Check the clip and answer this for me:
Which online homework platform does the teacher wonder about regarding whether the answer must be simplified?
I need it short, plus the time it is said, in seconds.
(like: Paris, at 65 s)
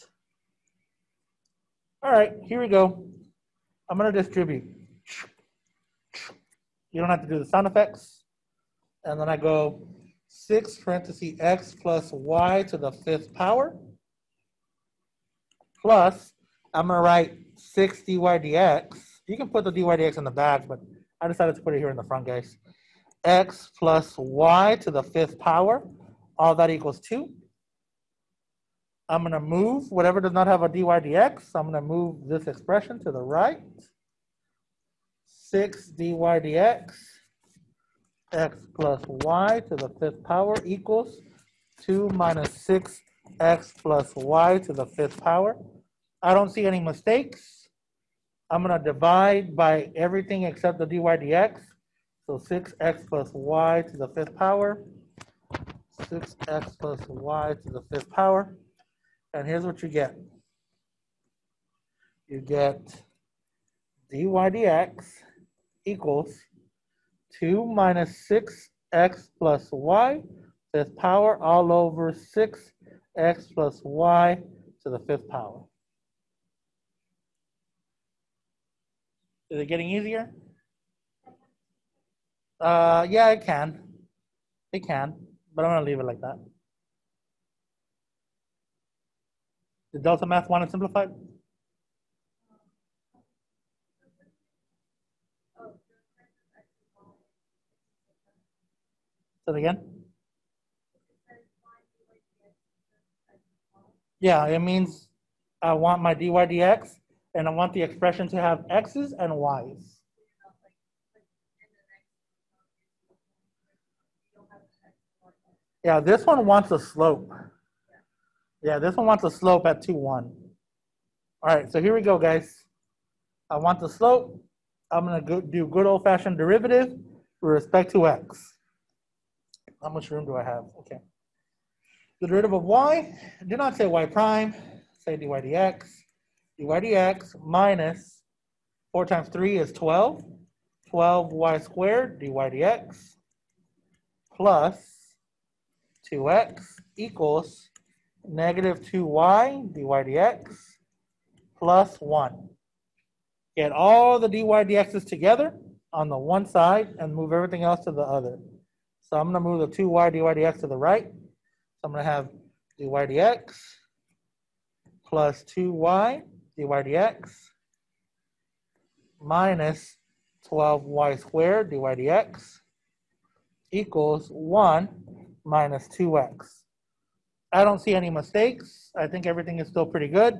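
Delta Math, at 90 s.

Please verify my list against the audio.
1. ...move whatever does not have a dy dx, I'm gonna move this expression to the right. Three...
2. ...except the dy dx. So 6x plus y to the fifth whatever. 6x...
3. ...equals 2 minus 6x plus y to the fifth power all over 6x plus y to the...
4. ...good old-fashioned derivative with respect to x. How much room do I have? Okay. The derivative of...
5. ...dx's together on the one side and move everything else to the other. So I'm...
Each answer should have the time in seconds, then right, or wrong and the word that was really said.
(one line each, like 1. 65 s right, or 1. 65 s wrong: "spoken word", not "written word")
1. 29 s wrong: "Six", not "Three"
2. 50 s wrong: "power", not "whatever"
3. 65 s right
4. 125 s right
5. 154 s right.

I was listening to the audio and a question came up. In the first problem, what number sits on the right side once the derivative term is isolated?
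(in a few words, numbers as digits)
2.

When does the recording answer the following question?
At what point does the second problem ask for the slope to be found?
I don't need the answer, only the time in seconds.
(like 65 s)
119 s.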